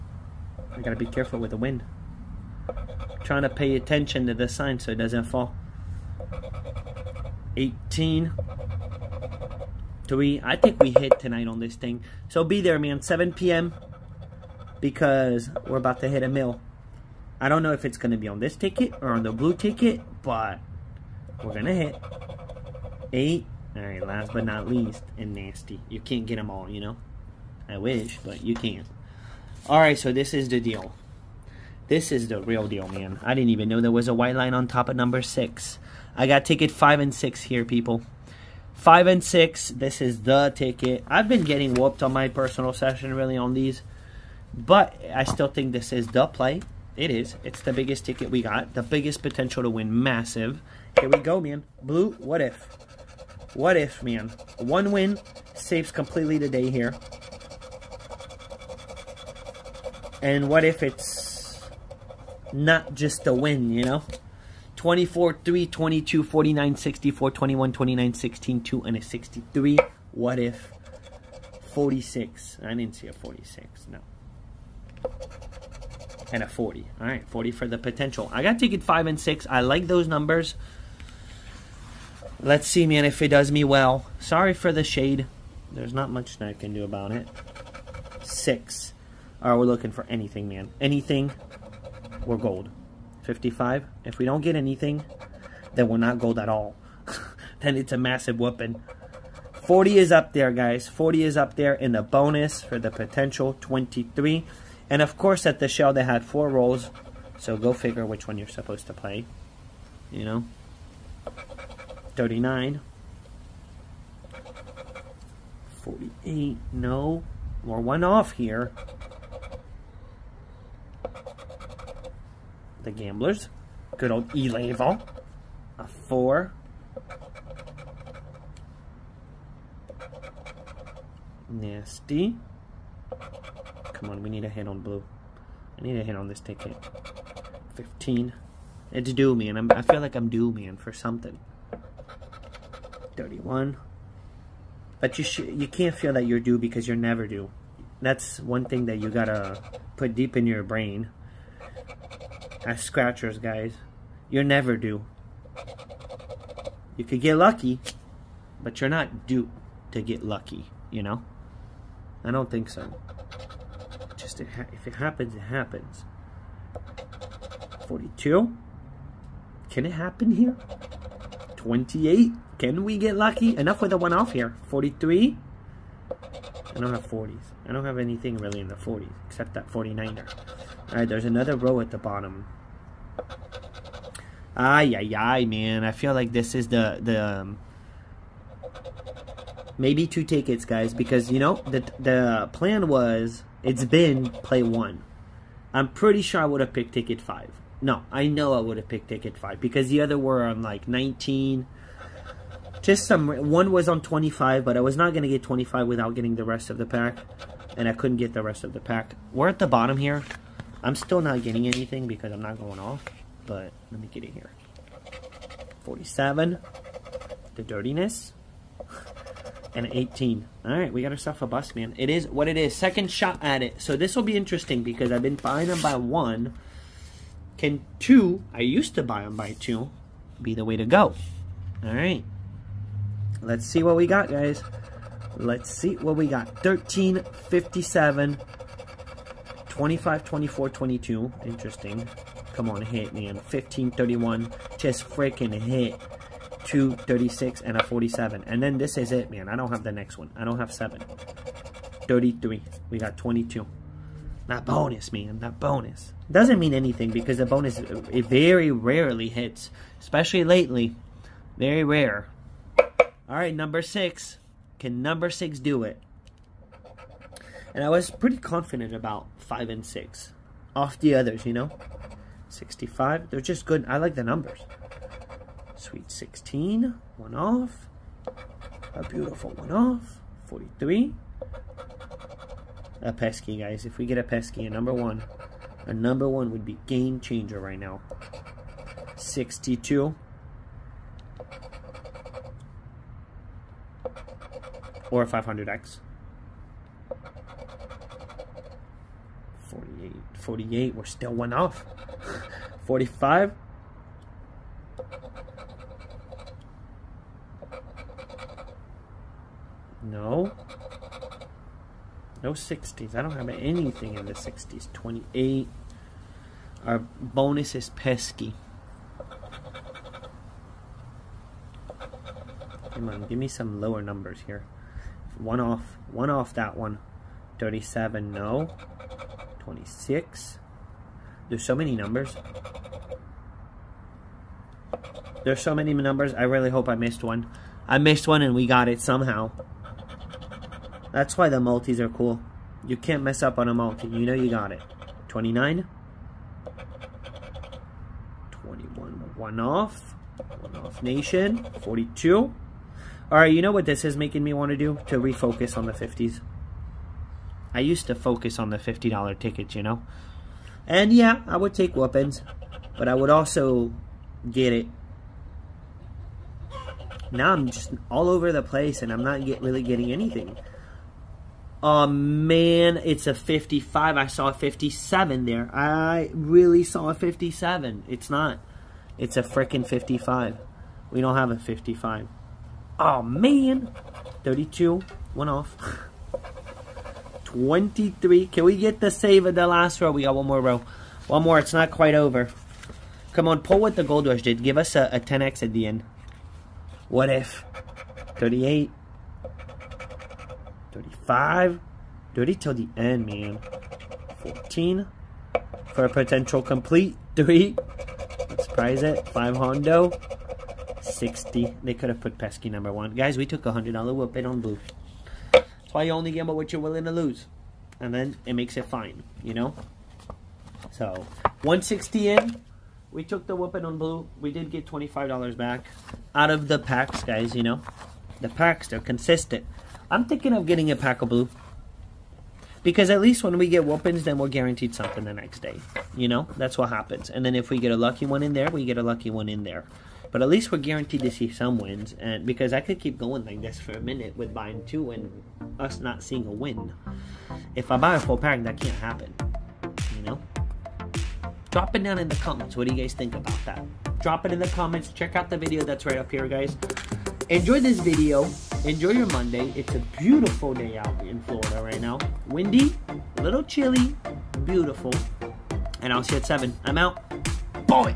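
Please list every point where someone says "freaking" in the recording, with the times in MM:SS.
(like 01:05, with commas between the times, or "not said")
04:05, 06:19.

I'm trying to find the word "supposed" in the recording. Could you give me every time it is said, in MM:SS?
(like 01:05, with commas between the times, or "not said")
01:48.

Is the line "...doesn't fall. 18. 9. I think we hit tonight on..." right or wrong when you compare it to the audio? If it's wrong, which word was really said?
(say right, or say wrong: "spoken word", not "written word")
wrong: "3", not "9".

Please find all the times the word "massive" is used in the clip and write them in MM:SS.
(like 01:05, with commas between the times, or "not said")
00:50, 01:37.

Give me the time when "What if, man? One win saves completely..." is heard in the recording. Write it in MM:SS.
00:53.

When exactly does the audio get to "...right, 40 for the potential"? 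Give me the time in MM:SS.
01:17.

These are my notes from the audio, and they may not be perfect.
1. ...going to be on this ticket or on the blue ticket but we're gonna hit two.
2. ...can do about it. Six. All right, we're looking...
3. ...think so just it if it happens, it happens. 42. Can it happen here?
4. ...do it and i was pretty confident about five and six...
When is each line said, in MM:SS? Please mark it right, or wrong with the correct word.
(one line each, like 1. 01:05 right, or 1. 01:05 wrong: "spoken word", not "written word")
1. 00:17 wrong: "eight", not "two"
2. 01:26 right
3. 02:42 right
4. 04:25 right.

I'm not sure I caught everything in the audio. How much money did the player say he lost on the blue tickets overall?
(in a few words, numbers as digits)
$100.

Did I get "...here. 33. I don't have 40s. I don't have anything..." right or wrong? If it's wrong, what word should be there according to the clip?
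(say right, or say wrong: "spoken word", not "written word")
wrong: "43", not "33".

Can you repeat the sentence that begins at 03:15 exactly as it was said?
I'm pretty sure I would have picked ticket five.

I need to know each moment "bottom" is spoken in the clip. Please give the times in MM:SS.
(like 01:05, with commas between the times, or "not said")
03:01, 03:29.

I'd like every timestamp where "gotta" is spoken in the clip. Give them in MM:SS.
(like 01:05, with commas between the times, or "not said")
00:00, 02:29.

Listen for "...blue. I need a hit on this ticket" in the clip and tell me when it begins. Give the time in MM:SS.
02:14.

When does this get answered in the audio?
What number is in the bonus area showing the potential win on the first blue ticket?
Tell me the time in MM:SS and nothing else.
01:40.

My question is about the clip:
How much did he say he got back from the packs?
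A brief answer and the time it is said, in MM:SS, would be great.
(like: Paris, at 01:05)
$25, at 07:04.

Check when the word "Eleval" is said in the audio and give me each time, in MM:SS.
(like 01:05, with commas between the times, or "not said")
02:04.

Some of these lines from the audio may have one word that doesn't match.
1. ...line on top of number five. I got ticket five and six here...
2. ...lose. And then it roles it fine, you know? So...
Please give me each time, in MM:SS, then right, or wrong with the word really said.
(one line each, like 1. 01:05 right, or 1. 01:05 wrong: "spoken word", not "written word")
1. 00:34 wrong: "six", not "five"
2. 06:57 wrong: "makes", not "roles".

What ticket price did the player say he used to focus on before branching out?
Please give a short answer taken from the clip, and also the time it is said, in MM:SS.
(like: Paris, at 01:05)
$50, at 05:58.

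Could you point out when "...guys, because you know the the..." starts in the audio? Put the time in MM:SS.
03:10.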